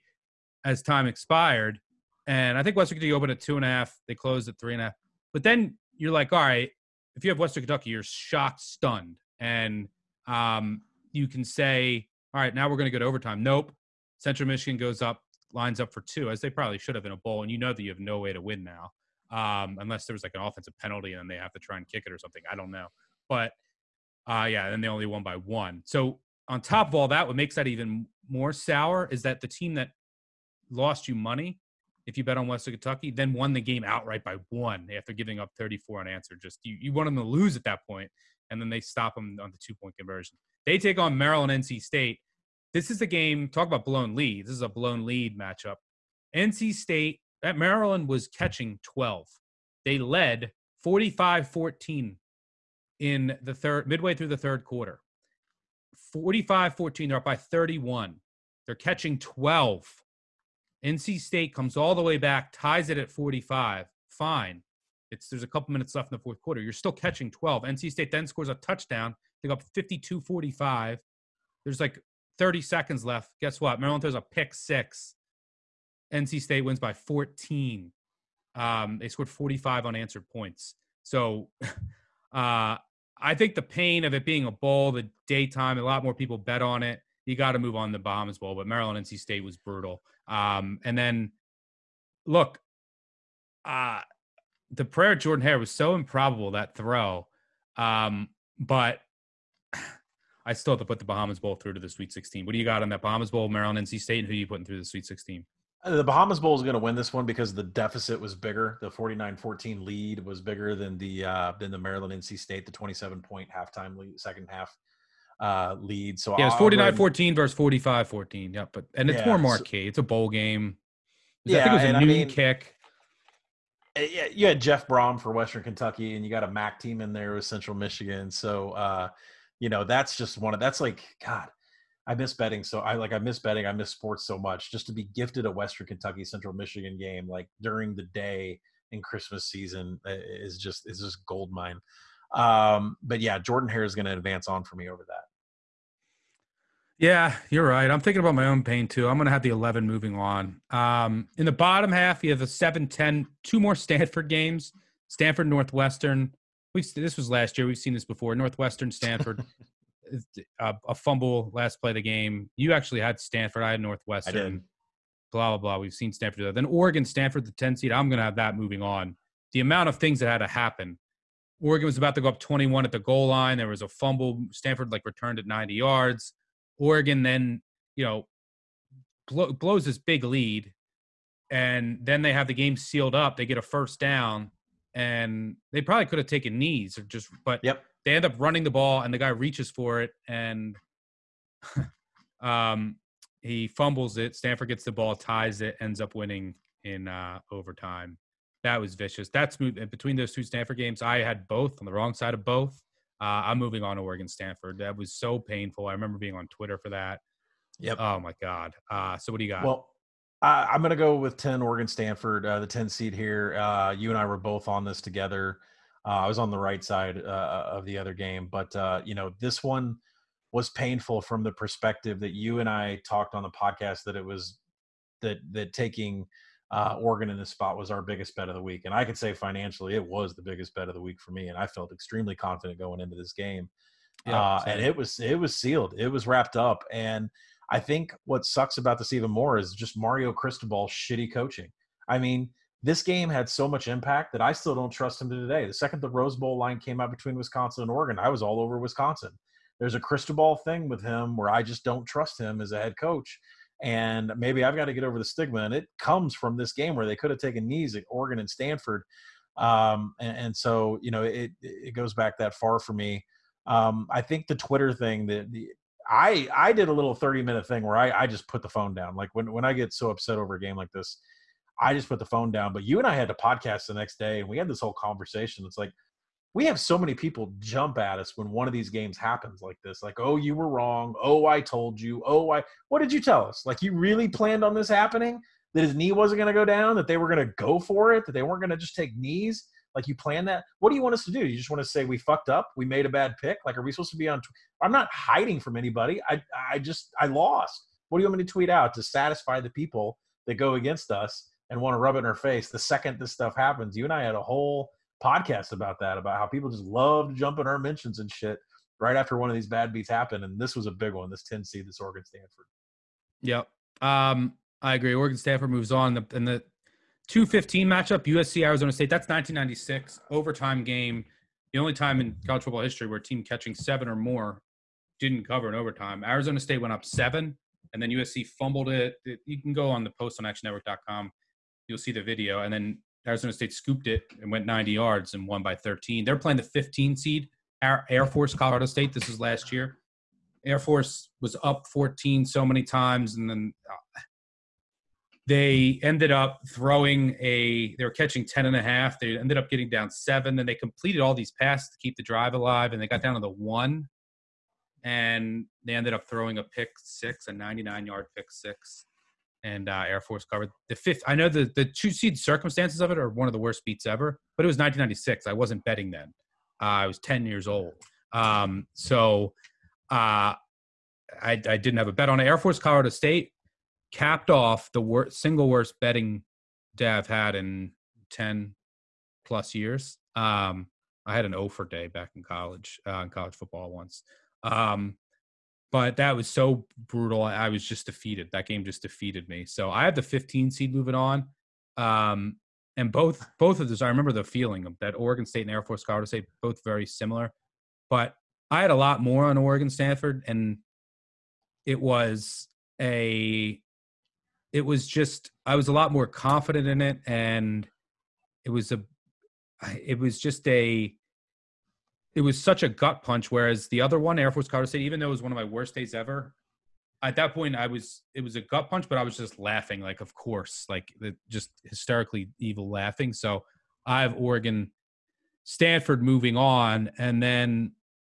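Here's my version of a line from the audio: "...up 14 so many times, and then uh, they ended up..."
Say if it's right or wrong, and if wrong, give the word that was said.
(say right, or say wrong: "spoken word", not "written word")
right.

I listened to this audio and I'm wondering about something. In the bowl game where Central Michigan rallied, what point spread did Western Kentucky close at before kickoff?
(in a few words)
3.5.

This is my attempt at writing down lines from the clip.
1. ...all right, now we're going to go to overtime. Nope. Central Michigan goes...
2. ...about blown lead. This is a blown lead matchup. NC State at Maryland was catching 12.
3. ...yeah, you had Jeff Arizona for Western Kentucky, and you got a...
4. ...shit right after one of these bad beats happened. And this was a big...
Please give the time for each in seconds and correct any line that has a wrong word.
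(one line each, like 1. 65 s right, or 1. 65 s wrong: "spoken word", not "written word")
1. 12 s right
2. 43 s right
3. 124 s wrong: "Brohm", not "Arizona"
4. 308 s right.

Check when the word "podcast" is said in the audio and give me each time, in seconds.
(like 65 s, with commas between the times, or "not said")
223 s, 273 s, 305 s.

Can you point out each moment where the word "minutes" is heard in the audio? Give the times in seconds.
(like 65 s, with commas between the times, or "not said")
65 s, 267 s.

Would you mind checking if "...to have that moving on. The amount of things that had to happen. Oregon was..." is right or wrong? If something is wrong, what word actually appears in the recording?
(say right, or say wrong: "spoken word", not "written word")
right.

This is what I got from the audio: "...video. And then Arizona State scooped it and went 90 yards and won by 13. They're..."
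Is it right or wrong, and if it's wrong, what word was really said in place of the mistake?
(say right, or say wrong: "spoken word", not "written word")
right.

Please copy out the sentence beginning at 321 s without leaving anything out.
The only time in college football history where a team catching seven or more didn't cover in overtime.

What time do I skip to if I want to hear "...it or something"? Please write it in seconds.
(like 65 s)
22 s.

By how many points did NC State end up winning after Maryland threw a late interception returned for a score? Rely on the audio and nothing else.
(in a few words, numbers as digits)
14.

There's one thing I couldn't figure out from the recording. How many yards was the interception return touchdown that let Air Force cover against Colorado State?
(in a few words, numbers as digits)
99.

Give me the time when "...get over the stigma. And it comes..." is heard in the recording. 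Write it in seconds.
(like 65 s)
254 s.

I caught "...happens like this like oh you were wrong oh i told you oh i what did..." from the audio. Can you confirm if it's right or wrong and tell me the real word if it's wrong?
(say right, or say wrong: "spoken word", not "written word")
right.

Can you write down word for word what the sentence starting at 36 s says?
Just you, you want them to lose at that point, and then they stop them on the two point conversion.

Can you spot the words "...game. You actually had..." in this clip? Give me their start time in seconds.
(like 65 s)
162 s.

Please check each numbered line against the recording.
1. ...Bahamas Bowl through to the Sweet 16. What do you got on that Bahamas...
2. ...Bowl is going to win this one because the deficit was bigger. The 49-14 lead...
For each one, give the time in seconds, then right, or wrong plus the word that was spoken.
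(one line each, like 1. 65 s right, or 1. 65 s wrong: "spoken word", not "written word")
1. 101 s right
2. 106 s right.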